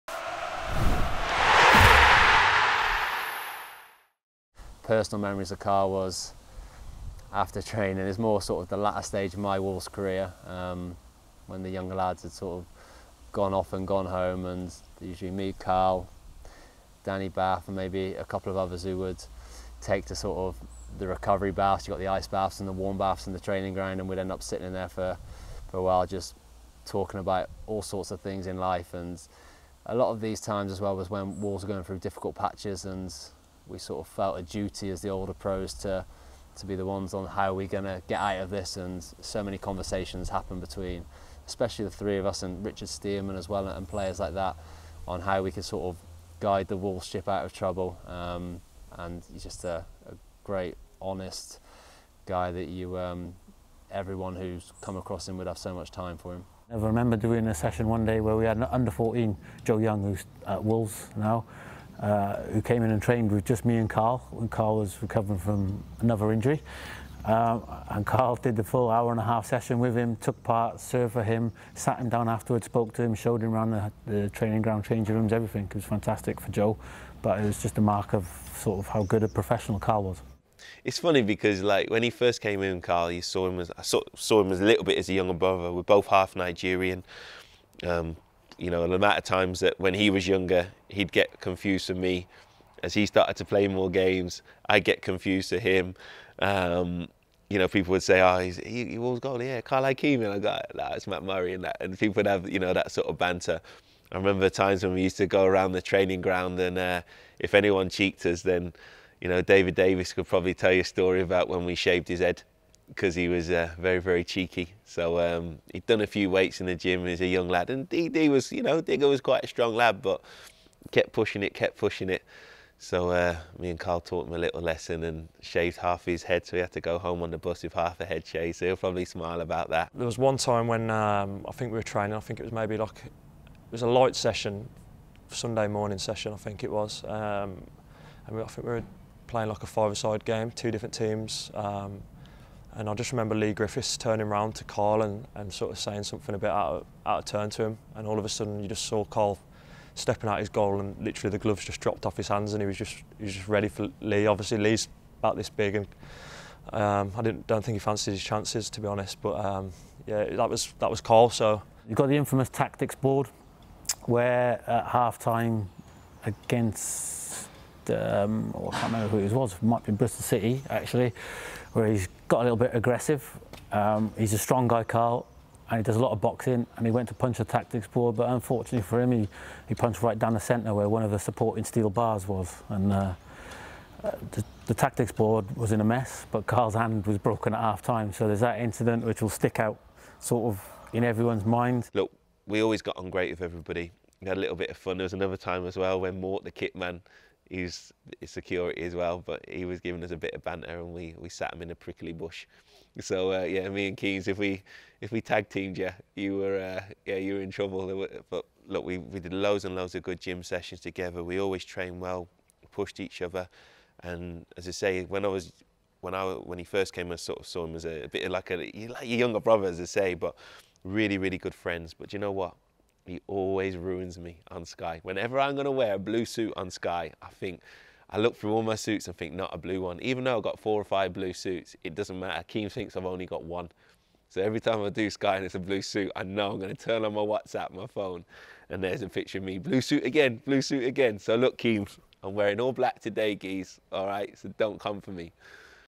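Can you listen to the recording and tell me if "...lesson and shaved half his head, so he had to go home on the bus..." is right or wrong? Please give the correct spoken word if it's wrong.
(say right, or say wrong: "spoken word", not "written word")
right.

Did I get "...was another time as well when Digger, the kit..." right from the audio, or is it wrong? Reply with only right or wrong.
wrong.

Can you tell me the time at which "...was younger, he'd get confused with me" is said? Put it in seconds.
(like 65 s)
90 s.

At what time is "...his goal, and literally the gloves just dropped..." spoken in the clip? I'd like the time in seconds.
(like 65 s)
150 s.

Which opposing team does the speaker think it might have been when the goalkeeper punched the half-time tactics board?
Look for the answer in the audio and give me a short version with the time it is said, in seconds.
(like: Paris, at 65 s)
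Bristol City, at 169 s.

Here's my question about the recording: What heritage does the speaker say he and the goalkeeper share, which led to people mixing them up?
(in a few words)
Half Nigerian.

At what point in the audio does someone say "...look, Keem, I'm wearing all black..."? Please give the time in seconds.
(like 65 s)
241 s.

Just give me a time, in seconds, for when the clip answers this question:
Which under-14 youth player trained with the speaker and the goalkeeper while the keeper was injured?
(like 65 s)
59 s.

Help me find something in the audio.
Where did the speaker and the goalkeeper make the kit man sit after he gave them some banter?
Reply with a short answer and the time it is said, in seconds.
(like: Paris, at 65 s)
A prickly bush, at 201 s.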